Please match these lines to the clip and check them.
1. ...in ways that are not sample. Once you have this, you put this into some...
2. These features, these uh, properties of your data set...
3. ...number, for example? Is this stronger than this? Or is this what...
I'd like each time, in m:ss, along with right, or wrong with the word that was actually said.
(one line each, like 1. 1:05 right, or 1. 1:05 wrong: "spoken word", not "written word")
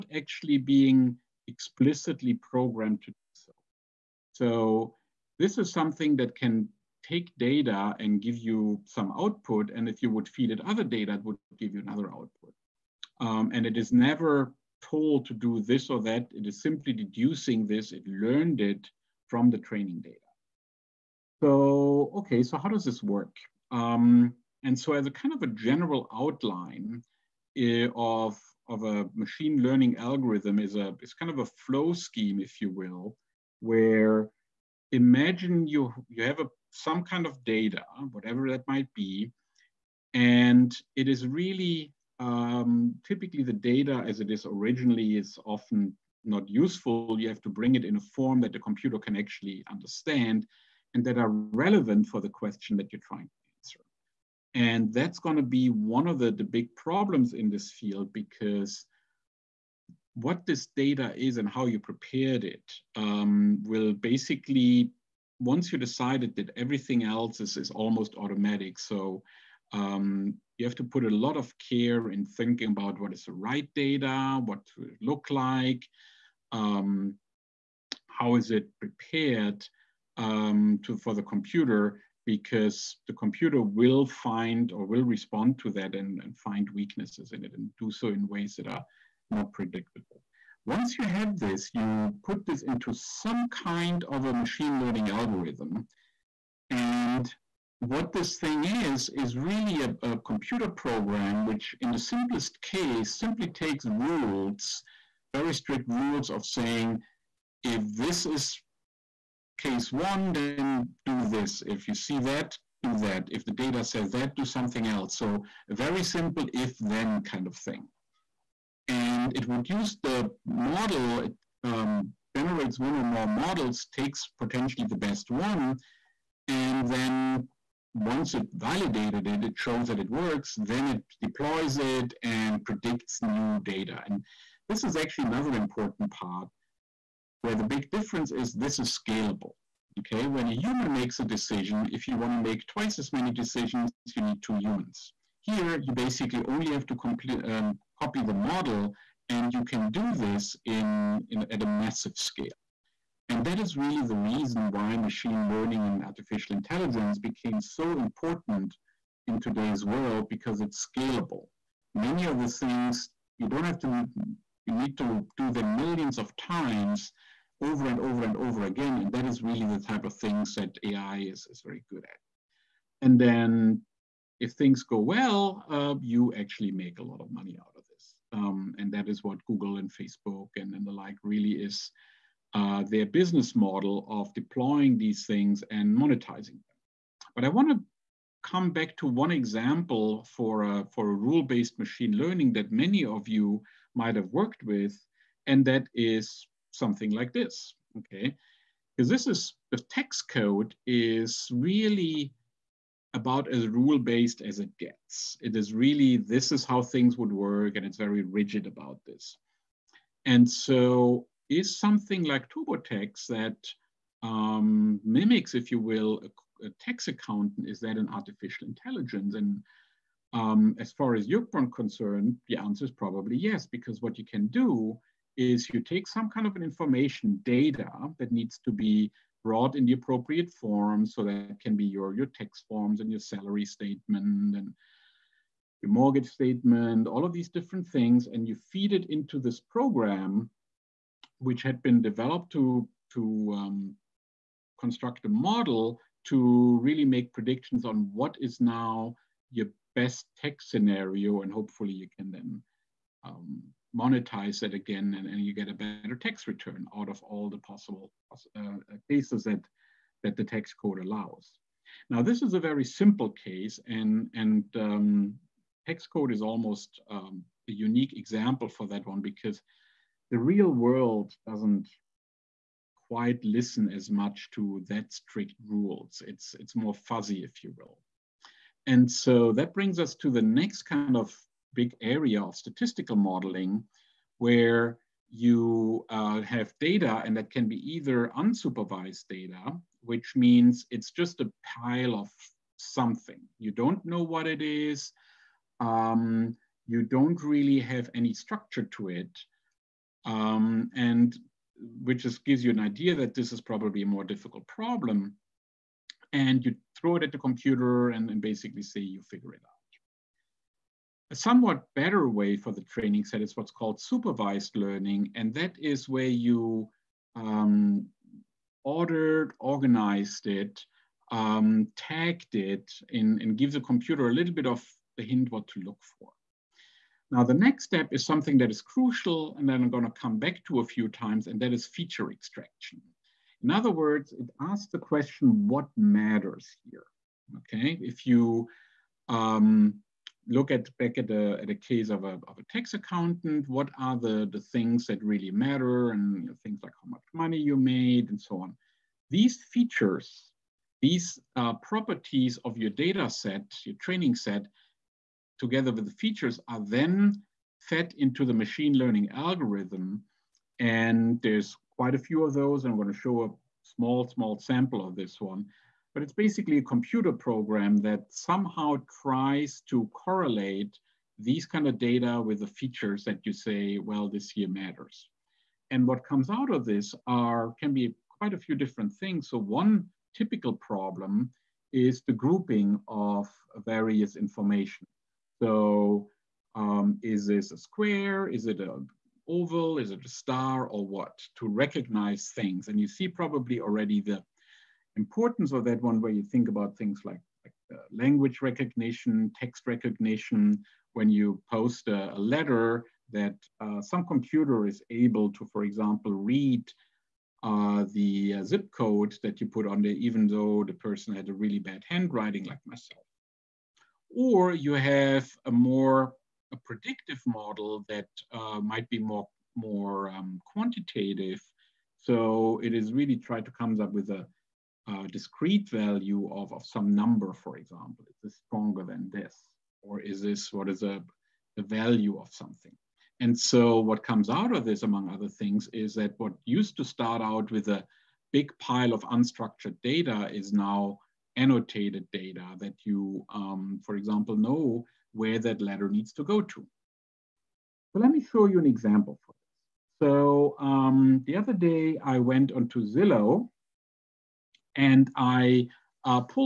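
1. 1:28 wrong: "predictable", not "sample"
2. 5:49 right
3. 7:07 right.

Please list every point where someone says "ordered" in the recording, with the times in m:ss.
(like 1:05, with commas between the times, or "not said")
5:18.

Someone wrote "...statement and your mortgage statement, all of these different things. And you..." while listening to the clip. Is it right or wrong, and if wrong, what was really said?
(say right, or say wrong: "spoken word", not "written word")
right.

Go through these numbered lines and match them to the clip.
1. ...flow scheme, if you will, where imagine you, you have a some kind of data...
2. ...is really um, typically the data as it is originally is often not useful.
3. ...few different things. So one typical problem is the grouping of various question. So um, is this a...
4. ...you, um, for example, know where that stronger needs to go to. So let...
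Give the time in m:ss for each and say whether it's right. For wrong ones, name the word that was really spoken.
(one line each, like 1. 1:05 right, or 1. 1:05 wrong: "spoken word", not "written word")
1. 0:31 right
2. 0:41 right
3. 6:18 wrong: "information", not "question"
4. 7:23 wrong: "letter", not "stronger".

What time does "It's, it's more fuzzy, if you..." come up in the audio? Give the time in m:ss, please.
4:36.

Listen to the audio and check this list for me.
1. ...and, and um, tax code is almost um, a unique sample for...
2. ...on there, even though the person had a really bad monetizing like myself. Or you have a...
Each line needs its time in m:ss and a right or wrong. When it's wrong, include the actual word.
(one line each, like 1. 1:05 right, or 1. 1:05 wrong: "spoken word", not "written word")
1. 4:23 wrong: "example", not "sample"
2. 6:49 wrong: "handwriting", not "monetizing".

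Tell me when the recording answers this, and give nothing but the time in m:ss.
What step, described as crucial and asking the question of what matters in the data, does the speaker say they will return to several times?
5:31.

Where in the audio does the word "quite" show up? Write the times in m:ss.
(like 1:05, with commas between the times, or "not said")
4:33, 6:01, 6:18.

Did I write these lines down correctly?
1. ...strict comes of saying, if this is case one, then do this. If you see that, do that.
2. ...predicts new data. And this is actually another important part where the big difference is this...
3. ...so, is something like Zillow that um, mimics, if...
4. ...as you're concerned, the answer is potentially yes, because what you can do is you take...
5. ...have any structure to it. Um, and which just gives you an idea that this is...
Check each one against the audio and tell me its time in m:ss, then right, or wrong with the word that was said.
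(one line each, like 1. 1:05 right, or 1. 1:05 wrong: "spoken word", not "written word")
1. 1:45 wrong: "rules", not "comes"
2. 2:12 right
3. 3:30 wrong: "TurboTax", not "Zillow"
4. 3:41 wrong: "probably", not "potentially"
5. 4:57 right.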